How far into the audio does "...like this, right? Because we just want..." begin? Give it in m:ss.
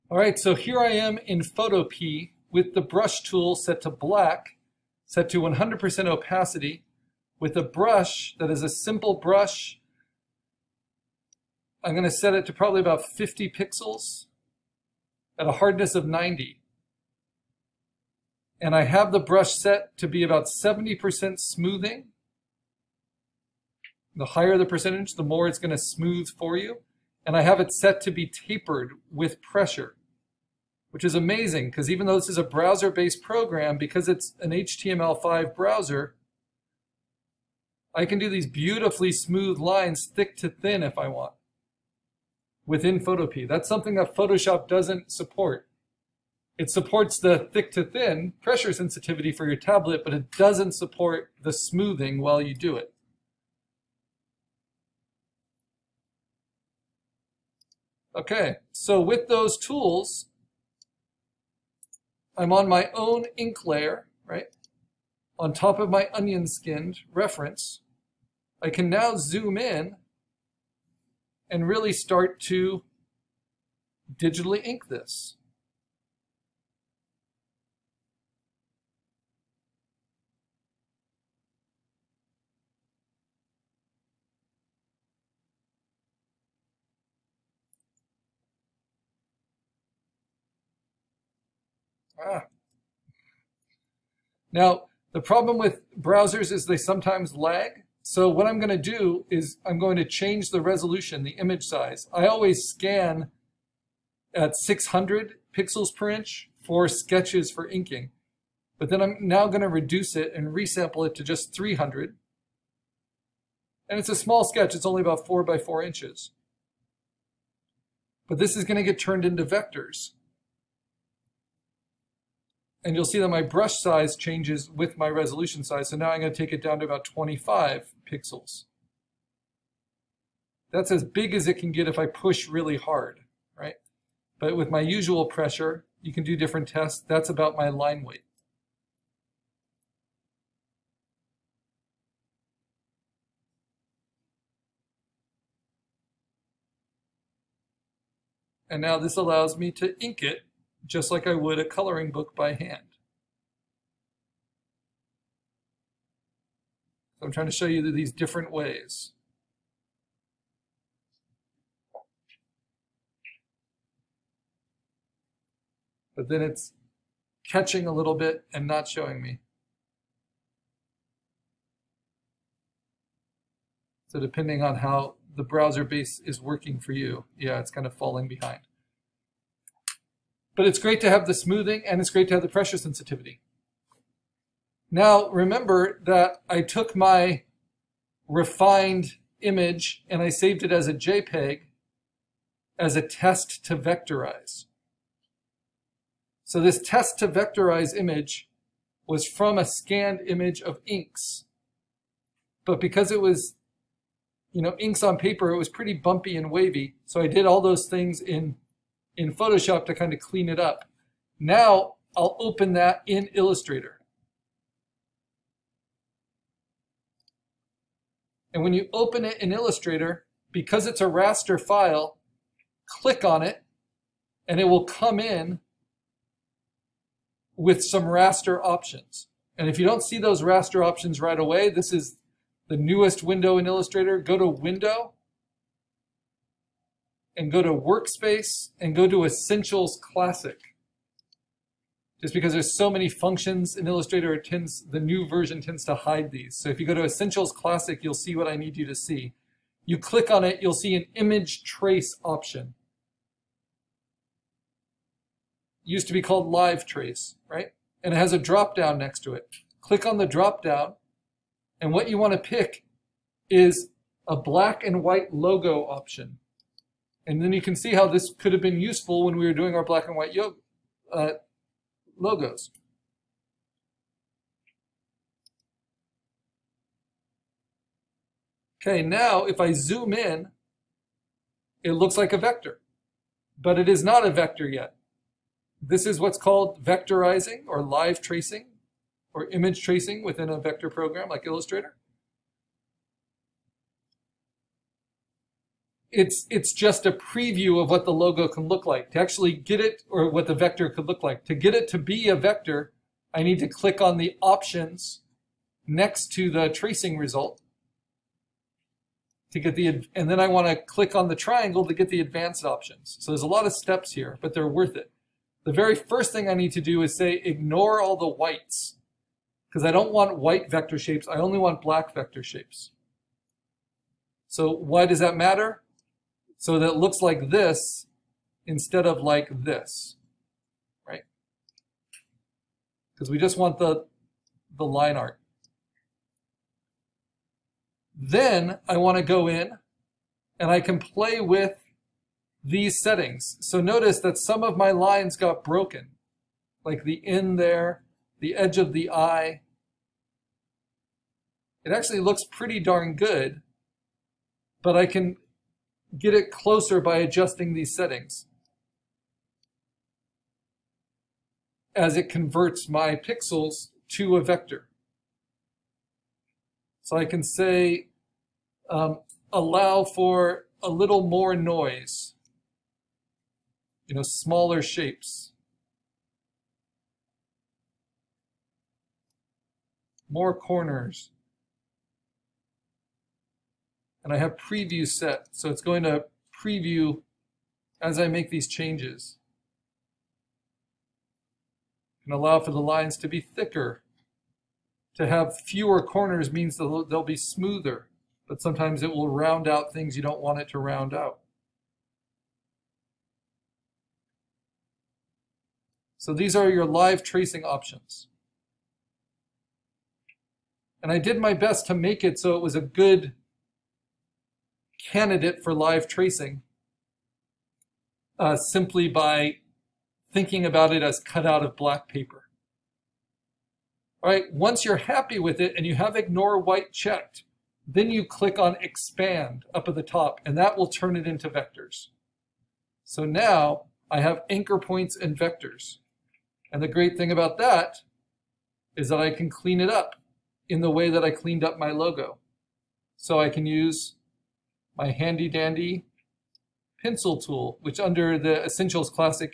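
5:29.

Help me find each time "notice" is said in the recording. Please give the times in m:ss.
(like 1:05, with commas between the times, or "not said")
5:43.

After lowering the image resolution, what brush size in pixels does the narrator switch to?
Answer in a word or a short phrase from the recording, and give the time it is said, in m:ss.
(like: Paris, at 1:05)
25 pixels, at 2:07.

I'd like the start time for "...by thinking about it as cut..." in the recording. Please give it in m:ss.
6:59.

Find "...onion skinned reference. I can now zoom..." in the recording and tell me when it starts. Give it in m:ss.
1:06.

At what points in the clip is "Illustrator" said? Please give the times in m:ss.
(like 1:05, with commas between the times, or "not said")
3:33, 3:39, 3:53, 4:03, 4:51.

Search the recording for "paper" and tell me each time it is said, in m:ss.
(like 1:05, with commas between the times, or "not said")
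3:25, 7:02.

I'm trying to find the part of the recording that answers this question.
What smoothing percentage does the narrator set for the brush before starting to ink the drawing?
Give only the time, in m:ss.
0:20.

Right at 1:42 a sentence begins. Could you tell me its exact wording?
I always scan at 600 pixels per inch for sketches for inking.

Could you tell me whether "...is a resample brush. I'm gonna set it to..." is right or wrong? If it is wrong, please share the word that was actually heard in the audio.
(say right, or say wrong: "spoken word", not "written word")
wrong: "simple", not "resample".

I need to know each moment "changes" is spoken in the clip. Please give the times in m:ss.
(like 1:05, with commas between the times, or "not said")
1:40, 2:04, 6:28.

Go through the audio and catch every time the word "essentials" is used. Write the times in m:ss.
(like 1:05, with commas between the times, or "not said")
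3:59, 4:07, 7:28.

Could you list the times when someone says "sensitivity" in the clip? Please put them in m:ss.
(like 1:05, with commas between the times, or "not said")
0:48, 3:02.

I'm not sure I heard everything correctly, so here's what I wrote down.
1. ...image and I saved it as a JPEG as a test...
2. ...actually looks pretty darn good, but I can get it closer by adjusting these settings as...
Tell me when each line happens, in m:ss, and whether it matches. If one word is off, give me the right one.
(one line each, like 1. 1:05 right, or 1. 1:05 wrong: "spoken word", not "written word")
1. 3:09 right
2. 5:51 right.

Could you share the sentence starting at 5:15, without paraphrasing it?
The very first thing I need to do is say ignore all the whites because I don't want white vector shapes.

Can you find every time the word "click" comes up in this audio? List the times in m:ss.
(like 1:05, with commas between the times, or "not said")
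3:42, 4:09, 4:19, 5:03, 5:10, 7:08.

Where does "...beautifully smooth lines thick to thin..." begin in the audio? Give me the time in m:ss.
0:38.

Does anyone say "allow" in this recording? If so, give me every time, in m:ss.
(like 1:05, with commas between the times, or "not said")
2:29, 6:09, 6:32.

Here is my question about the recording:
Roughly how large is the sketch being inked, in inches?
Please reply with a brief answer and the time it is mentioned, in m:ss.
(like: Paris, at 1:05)
4 by 4 inches, at 1:55.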